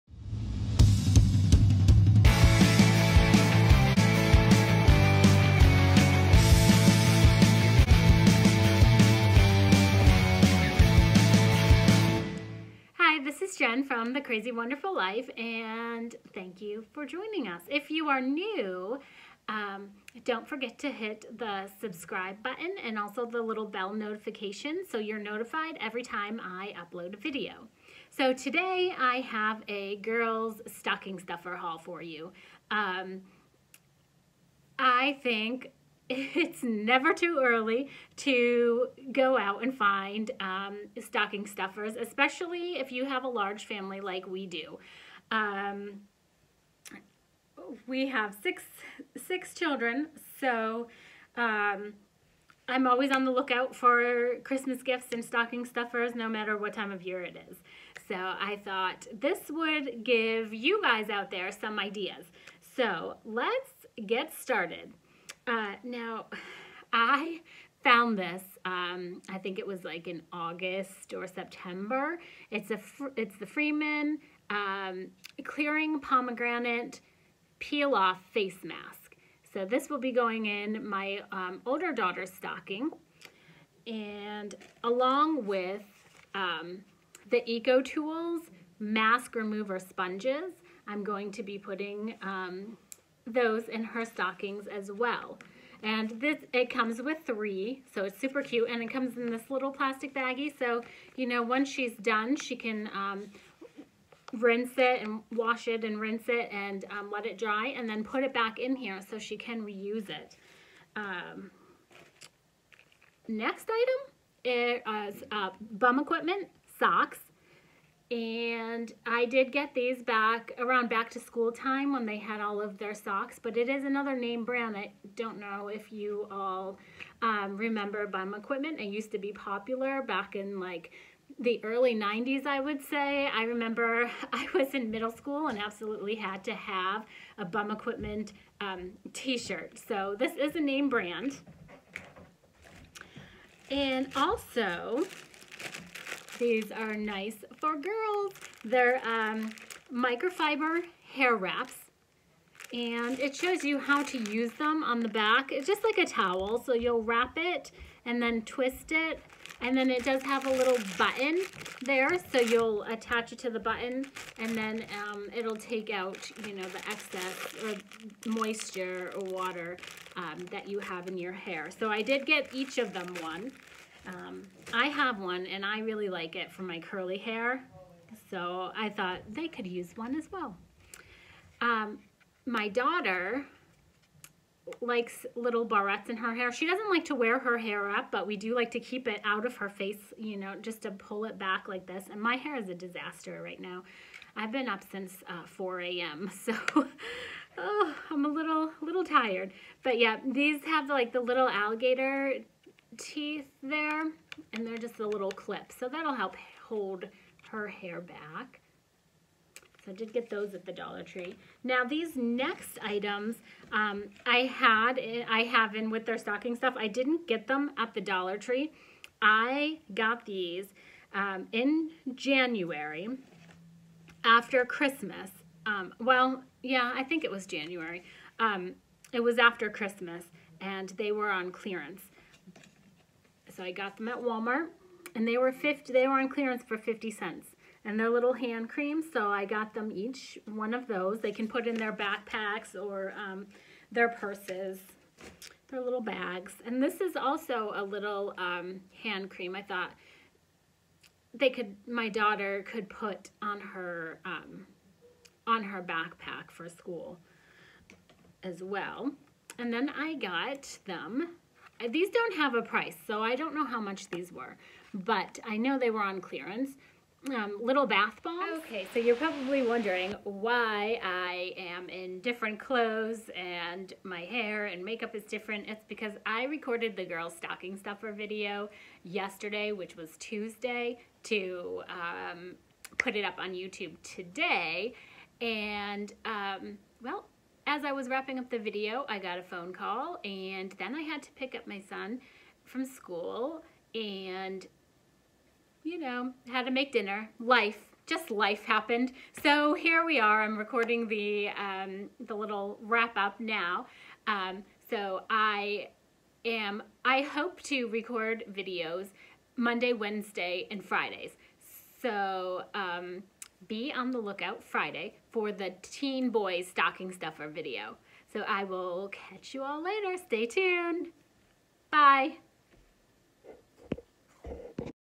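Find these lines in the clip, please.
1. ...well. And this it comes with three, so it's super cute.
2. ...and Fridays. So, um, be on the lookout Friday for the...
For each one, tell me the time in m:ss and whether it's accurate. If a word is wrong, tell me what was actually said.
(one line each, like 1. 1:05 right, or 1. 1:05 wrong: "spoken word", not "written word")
1. 1:34 right
2. 5:10 right.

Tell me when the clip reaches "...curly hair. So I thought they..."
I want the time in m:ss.
2:56.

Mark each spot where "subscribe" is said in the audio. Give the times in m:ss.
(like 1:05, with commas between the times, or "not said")
0:21.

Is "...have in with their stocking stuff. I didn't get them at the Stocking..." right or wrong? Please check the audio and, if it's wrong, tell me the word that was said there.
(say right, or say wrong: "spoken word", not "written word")
wrong: "Dollar", not "Stocking".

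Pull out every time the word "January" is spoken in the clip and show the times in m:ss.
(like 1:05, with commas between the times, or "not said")
3:42, 3:47.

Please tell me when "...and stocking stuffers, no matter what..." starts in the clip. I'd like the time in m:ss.
0:55.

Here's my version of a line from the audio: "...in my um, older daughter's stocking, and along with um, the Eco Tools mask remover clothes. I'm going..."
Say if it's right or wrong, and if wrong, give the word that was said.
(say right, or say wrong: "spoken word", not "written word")
wrong: "sponges", not "clothes".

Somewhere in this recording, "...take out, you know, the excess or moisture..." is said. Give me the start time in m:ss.
2:45.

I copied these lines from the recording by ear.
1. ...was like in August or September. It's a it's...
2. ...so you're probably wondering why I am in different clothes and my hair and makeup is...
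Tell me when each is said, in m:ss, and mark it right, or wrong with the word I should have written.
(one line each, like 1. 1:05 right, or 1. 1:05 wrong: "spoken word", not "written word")
1. 1:09 right
2. 4:28 right.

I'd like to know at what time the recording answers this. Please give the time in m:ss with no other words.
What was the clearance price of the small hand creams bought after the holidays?
3:56.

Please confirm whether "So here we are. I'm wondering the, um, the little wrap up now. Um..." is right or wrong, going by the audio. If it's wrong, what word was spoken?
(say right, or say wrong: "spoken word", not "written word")
wrong: "recording", not "wondering".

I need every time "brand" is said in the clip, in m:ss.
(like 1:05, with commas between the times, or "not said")
2:04, 2:20.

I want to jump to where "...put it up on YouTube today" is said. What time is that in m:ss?
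4:42.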